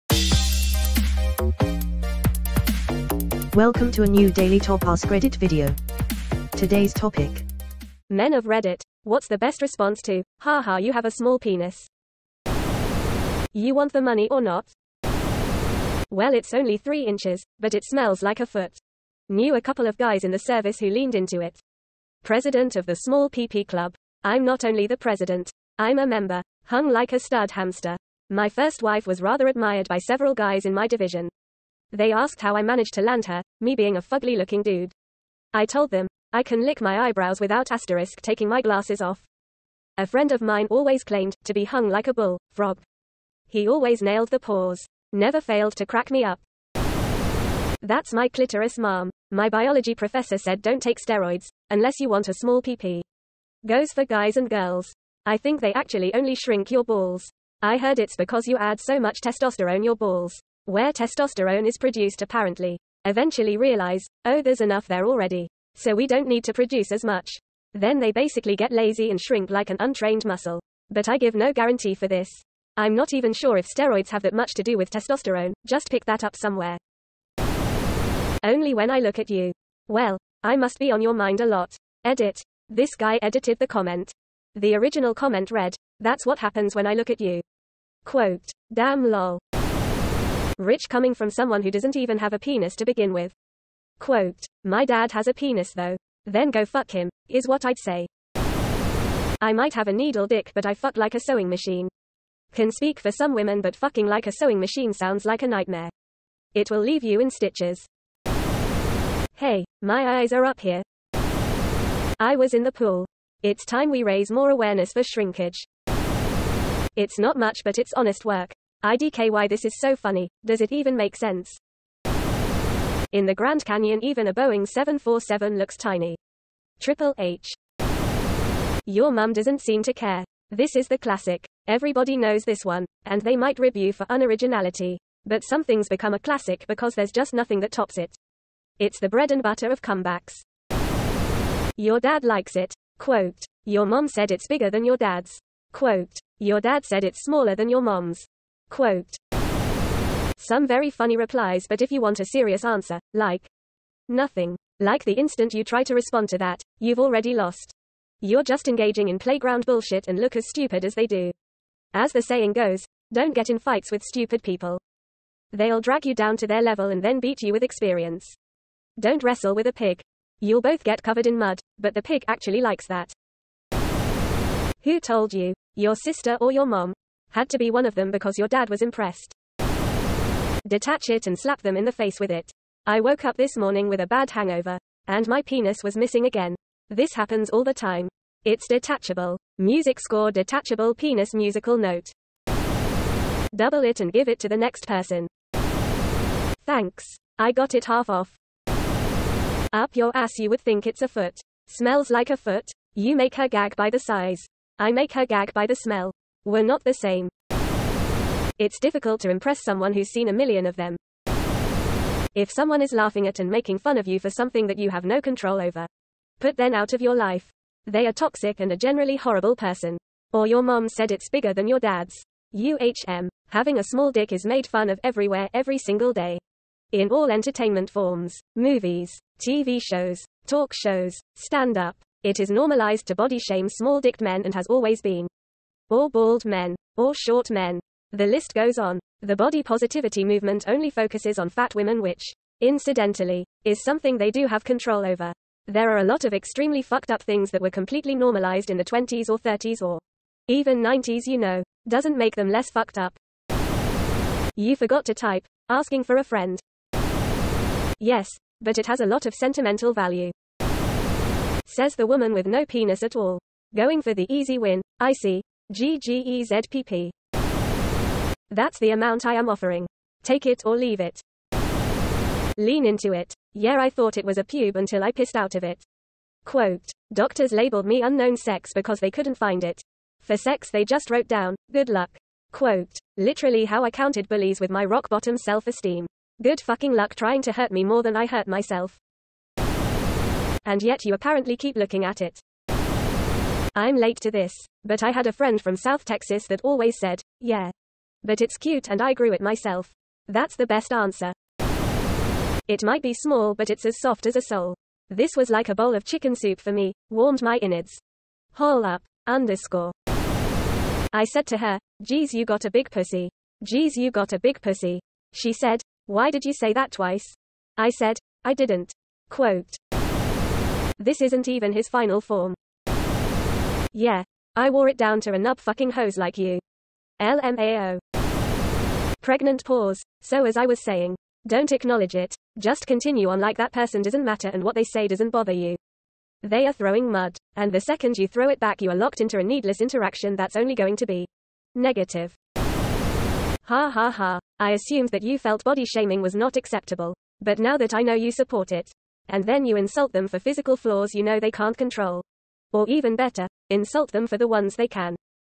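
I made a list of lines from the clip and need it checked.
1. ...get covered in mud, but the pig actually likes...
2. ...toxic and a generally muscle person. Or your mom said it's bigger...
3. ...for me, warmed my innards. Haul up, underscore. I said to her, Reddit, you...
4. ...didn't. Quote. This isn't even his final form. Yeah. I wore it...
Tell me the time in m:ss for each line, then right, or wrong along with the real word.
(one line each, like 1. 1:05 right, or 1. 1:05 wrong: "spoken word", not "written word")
1. 2:50 right
2. 3:38 wrong: "horrible", not "muscle"
3. 5:06 wrong: "Geez", not "Reddit"
4. 5:18 right.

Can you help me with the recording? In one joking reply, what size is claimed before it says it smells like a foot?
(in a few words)
3 inches.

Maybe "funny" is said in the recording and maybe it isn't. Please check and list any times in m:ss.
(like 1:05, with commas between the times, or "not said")
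1:59, 2:30.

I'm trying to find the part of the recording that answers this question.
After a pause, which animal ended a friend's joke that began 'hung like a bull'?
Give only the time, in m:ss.
0:42.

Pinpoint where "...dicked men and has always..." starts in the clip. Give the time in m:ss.
3:54.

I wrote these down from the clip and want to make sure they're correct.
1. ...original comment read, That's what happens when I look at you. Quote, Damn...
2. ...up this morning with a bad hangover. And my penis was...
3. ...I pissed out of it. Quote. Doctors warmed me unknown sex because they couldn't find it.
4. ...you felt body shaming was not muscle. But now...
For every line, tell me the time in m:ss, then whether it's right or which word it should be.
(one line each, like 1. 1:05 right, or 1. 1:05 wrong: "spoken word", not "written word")
1. 1:24 right
2. 3:03 right
3. 4:35 wrong: "labeled", not "warmed"
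4. 5:45 wrong: "acceptable", not "muscle".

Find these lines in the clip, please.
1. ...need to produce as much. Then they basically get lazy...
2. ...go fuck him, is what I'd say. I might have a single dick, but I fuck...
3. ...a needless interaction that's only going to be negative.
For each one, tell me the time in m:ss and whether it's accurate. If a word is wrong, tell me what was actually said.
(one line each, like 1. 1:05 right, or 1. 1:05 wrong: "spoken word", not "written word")
1. 1:06 right
2. 1:36 wrong: "needle", not "single"
3. 5:39 right.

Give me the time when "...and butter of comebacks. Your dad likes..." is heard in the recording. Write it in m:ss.
2:19.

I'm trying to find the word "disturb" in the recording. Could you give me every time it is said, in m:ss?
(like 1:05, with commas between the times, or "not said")
not said.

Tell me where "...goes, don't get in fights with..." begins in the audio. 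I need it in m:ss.
2:42.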